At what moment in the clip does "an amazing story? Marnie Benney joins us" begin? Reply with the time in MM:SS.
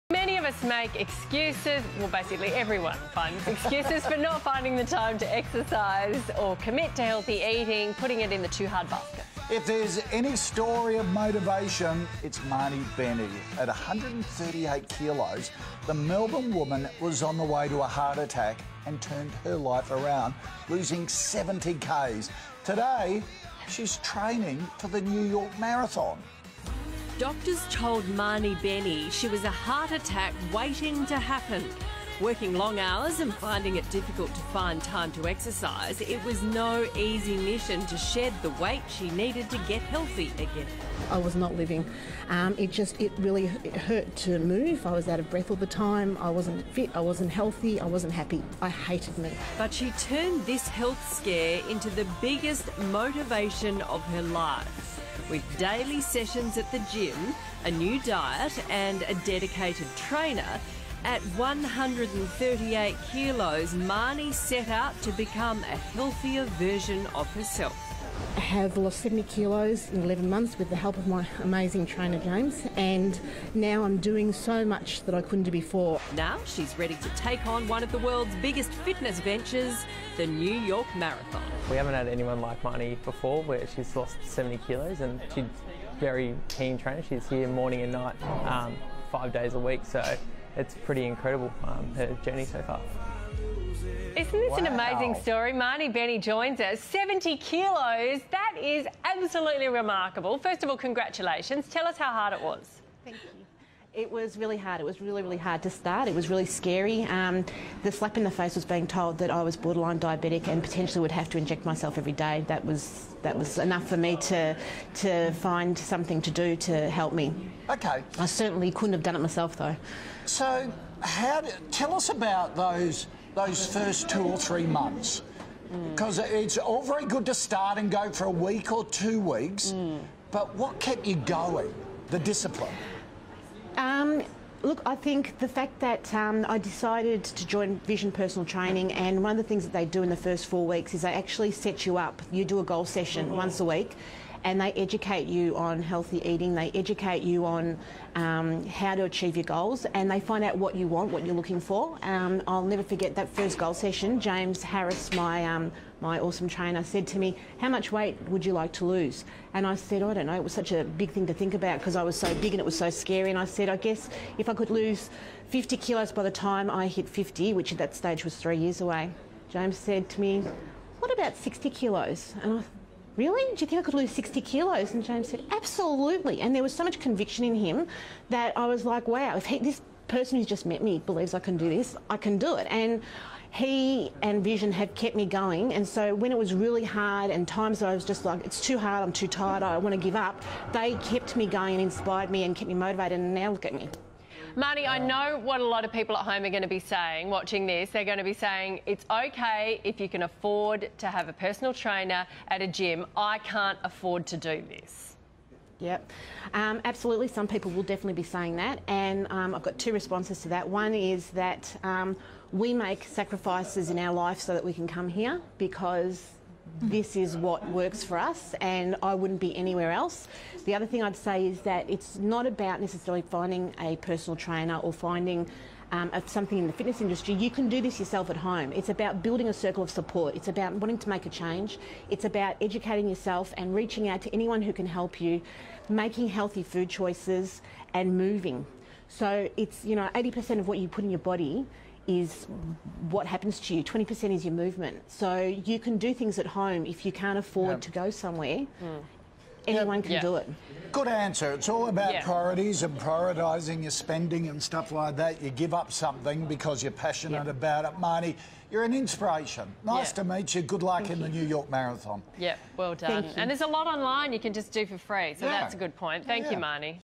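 01:34.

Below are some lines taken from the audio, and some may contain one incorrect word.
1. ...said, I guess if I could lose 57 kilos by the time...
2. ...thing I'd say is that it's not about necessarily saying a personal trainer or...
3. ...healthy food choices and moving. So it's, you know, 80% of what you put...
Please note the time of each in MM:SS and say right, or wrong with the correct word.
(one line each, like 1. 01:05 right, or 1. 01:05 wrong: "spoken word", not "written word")
1. 02:43 wrong: "50", not "57"
2. 03:40 wrong: "finding", not "saying"
3. 03:56 right.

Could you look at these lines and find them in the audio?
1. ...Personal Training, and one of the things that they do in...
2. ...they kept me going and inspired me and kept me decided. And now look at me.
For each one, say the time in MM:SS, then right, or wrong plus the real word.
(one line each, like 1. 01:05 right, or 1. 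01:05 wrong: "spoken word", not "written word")
1. 02:18 right
2. 03:10 wrong: "motivated", not "decided".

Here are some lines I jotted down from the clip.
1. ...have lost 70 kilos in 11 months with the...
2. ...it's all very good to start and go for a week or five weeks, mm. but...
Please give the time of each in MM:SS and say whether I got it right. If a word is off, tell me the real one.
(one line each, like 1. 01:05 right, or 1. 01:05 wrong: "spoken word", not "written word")
1. 01:08 right
2. 02:06 wrong: "two", not "five".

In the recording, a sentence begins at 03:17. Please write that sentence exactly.
They're going to be saying it's okay if you can afford to have a personal trainer at a gym.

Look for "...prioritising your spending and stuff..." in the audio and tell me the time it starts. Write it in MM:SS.
04:12.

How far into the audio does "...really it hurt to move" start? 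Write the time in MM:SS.
00:43.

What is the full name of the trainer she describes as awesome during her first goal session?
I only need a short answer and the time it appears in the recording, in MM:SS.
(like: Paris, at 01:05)
James Harris, at 02:34.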